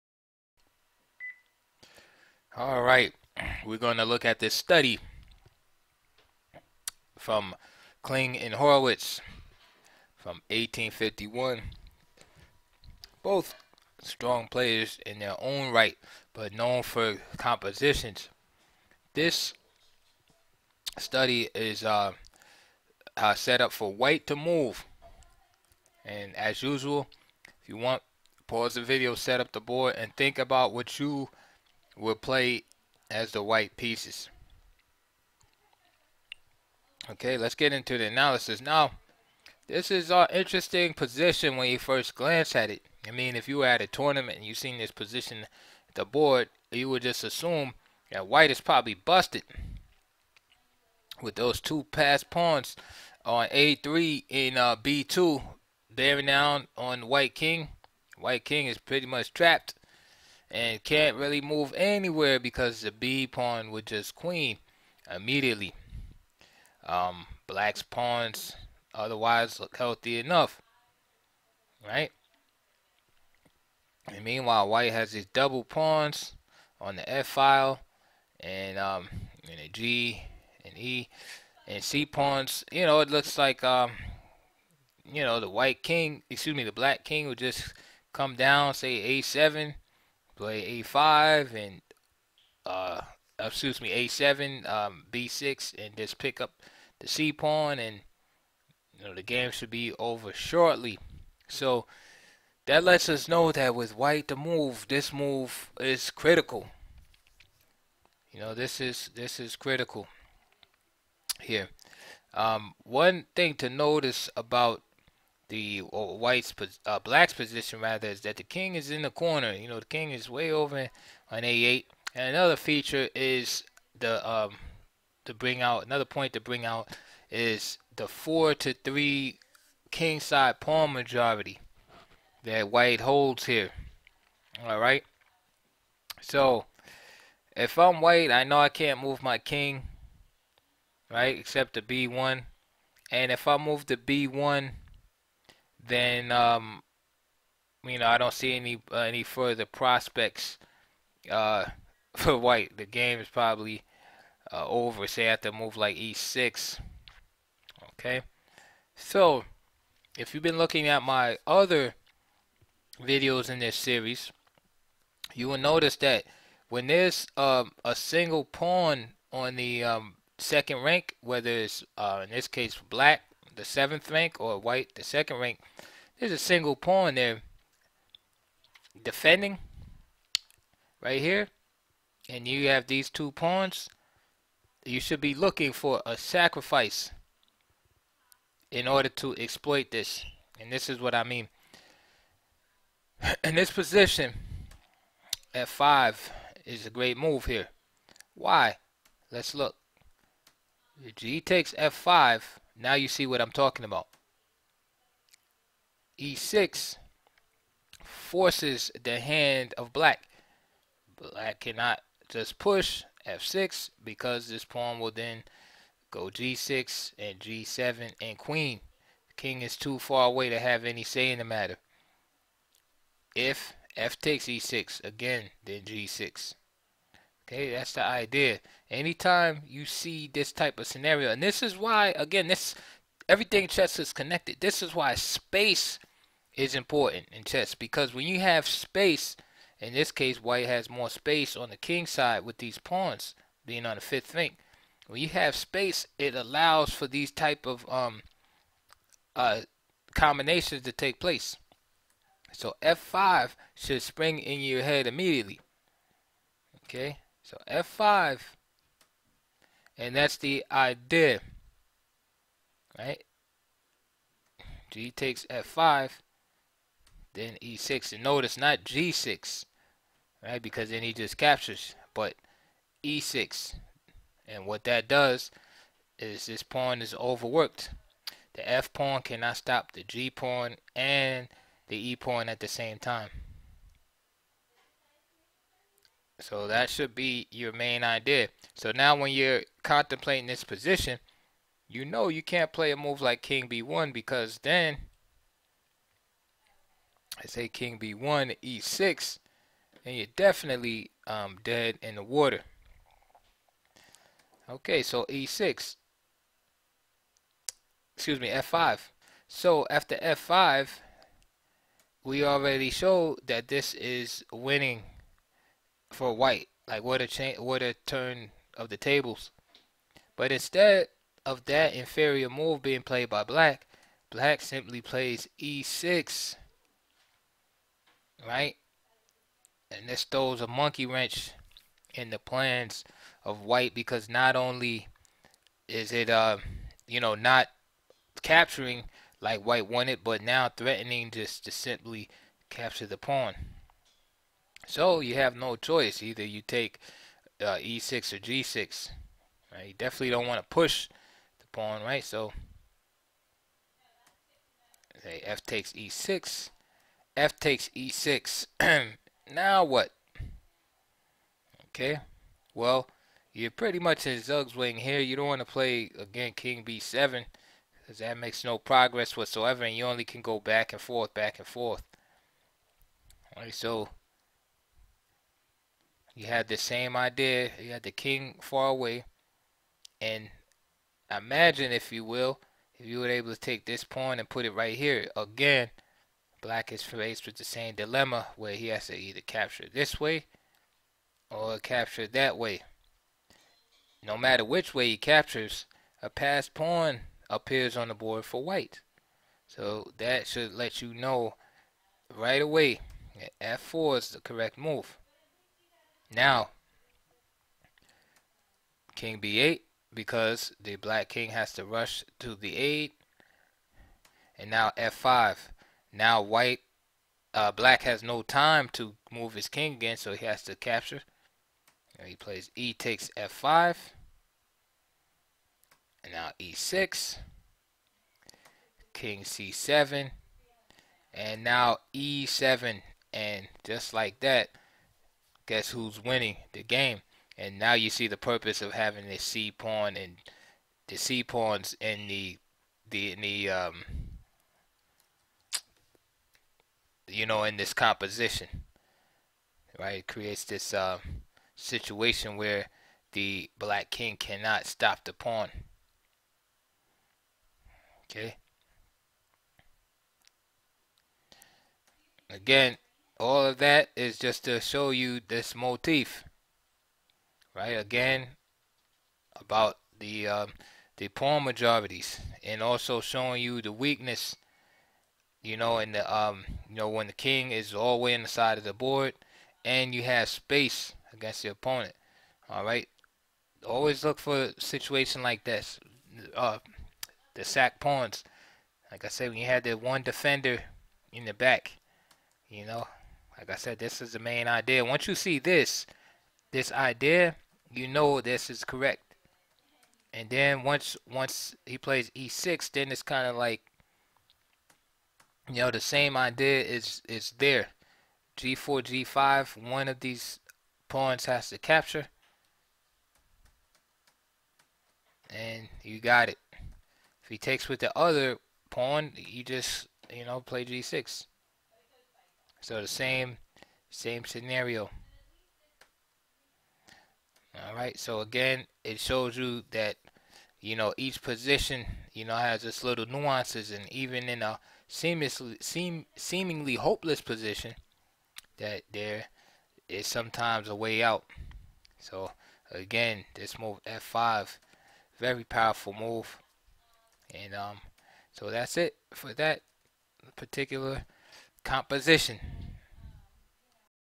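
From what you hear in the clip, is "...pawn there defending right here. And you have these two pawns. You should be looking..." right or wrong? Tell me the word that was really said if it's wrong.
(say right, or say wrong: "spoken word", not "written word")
right.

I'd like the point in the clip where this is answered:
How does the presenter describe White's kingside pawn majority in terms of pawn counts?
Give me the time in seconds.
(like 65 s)
128 s.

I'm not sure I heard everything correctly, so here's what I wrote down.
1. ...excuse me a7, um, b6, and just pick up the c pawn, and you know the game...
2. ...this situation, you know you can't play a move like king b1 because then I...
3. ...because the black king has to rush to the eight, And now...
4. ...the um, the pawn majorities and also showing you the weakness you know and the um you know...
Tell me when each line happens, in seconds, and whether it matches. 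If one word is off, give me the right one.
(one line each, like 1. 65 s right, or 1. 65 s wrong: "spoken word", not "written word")
1. 93 s right
2. 290 s wrong: "position", not "situation"
3. 410 s right
4. 470 s right.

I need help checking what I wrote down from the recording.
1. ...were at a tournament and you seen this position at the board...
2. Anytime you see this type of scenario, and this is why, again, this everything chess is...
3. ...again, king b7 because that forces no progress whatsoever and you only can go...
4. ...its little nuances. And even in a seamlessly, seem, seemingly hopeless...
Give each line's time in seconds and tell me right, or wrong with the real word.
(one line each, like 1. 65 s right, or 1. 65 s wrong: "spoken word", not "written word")
1. 43 s right
2. 228 s right
3. 366 s wrong: "makes", not "forces"
4. 532 s right.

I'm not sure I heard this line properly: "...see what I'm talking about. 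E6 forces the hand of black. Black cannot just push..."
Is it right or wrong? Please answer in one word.
right.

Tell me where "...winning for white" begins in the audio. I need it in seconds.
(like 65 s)
314 s.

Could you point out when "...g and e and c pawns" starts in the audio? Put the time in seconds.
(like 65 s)
79 s.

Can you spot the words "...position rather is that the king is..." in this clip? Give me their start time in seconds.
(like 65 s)
117 s.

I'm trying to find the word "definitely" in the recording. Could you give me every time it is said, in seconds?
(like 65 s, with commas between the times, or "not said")
300 s, 349 s.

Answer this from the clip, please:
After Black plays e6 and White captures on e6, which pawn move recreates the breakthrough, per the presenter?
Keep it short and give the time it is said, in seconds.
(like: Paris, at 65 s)
f4, at 403 s.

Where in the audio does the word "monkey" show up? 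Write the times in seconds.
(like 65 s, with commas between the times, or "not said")
330 s.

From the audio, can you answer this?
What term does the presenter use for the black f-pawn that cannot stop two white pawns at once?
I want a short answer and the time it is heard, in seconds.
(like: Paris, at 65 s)
overworked, at 277 s.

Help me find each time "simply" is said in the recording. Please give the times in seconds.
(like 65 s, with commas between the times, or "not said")
324 s, 341 s.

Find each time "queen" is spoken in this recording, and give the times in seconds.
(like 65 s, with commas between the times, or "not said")
64 s, 218 s.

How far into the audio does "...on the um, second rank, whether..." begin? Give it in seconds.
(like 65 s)
169 s.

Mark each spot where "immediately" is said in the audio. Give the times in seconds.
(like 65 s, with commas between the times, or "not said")
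65 s, 255 s.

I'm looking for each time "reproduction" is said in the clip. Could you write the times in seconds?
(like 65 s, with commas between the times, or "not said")
not said.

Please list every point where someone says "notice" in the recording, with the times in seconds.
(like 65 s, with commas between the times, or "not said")
113 s, 165 s, 268 s.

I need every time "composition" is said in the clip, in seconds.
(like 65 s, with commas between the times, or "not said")
17 s, 447 s, 551 s.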